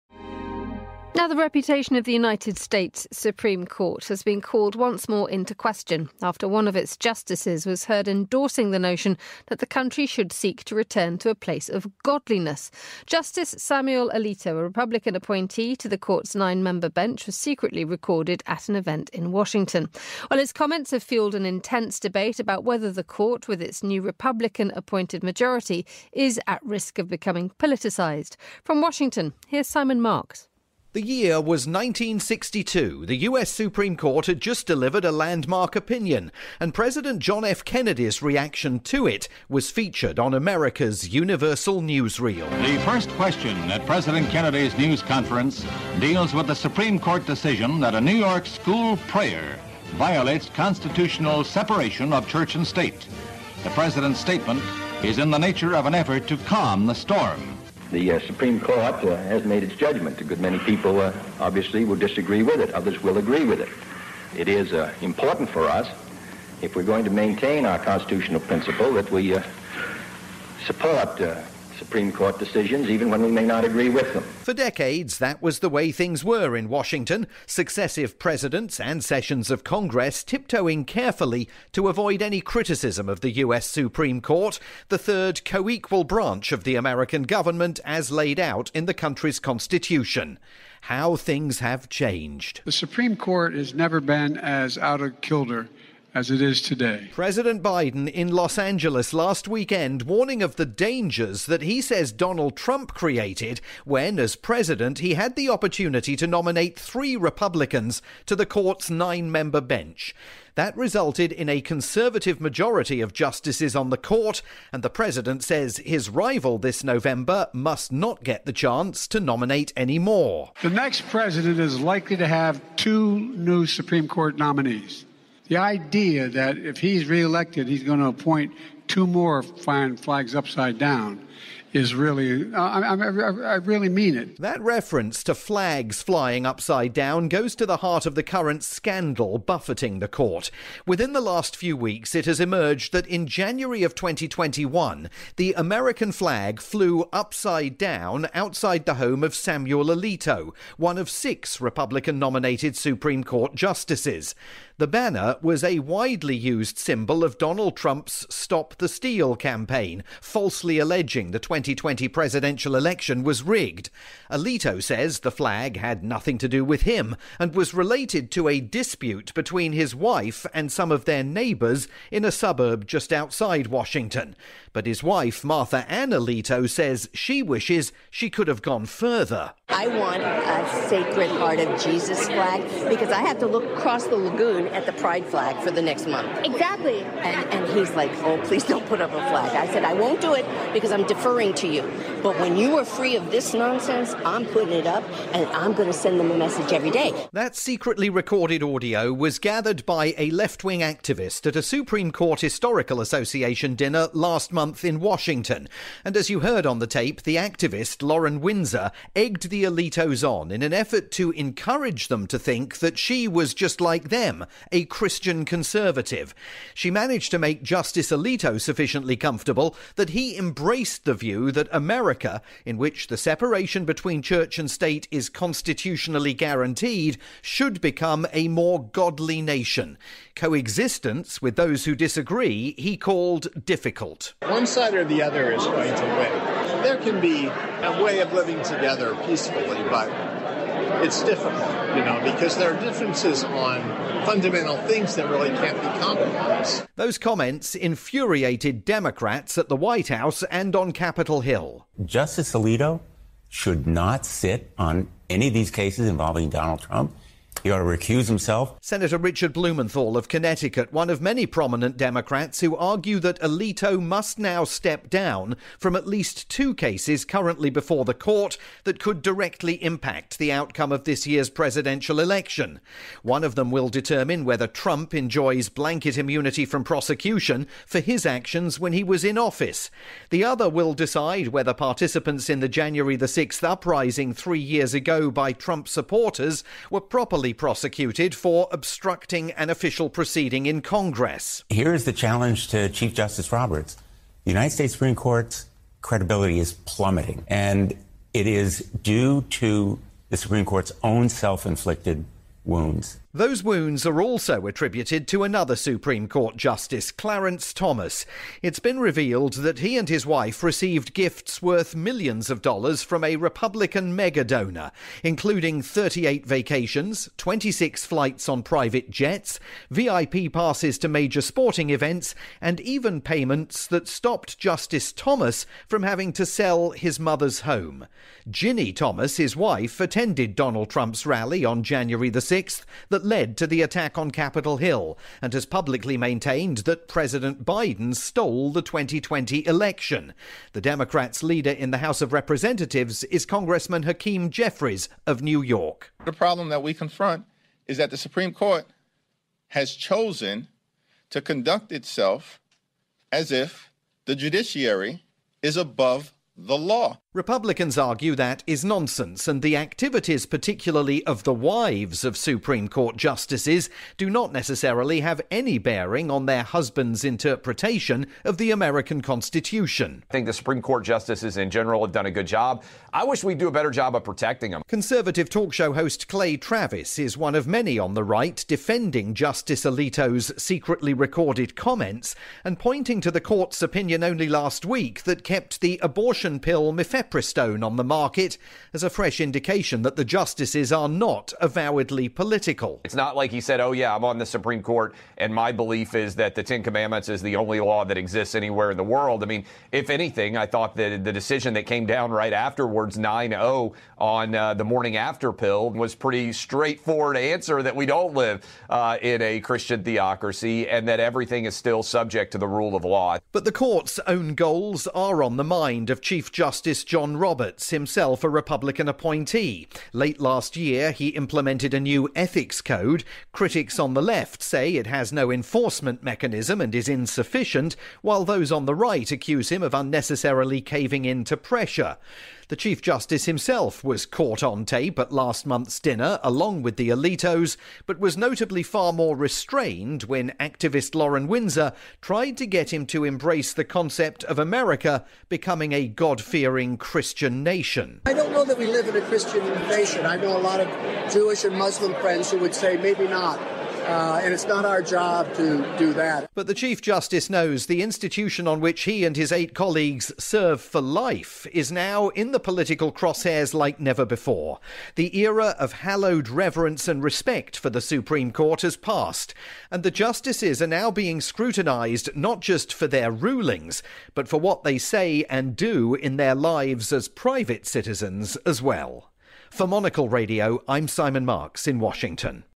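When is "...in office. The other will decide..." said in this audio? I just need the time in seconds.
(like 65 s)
279 s.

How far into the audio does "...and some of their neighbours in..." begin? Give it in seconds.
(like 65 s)
170 s.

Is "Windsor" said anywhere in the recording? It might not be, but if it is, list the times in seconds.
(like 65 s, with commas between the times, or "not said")
208 s, 441 s.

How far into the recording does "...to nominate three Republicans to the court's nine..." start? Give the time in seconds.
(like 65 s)
106 s.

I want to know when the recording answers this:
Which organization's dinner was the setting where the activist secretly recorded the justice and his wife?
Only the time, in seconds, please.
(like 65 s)
201 s.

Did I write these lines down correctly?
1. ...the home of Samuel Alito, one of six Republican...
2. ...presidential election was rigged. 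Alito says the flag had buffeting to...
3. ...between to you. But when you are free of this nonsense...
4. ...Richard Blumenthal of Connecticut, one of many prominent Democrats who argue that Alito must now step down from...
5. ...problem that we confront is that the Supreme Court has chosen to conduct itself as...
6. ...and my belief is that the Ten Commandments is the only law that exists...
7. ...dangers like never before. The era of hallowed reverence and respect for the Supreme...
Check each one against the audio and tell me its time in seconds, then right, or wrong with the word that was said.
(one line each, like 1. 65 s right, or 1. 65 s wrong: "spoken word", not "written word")
1. 148 s right
2. 162 s wrong: "nothing", not "buffeting"
3. 191 s wrong: "listen", not "between"
4. 259 s right
5. 346 s right
6. 395 s right
7. 463 s wrong: "crosshairs", not "dangers".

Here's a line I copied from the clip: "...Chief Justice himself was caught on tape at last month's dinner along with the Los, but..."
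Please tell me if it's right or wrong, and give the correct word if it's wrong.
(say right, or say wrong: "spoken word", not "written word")
wrong: "Alitos", not "Los".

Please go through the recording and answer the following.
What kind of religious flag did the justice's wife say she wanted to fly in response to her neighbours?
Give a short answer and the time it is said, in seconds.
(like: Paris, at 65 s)
Sacred Heart of Jesus, at 180 s.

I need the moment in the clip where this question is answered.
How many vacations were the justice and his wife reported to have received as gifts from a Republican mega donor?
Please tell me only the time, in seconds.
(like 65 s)
315 s.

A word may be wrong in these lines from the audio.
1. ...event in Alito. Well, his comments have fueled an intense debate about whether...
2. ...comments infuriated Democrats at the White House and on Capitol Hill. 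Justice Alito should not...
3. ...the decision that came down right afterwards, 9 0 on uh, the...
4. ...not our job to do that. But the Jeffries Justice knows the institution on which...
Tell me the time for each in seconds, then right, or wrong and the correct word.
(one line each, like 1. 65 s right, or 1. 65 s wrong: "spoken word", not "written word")
1. 18 s wrong: "Washington", not "Alito"
2. 247 s right
3. 401 s right
4. 454 s wrong: "Chief", not "Jeffries".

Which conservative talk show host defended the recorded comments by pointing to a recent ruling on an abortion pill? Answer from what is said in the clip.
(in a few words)
Clay Travis.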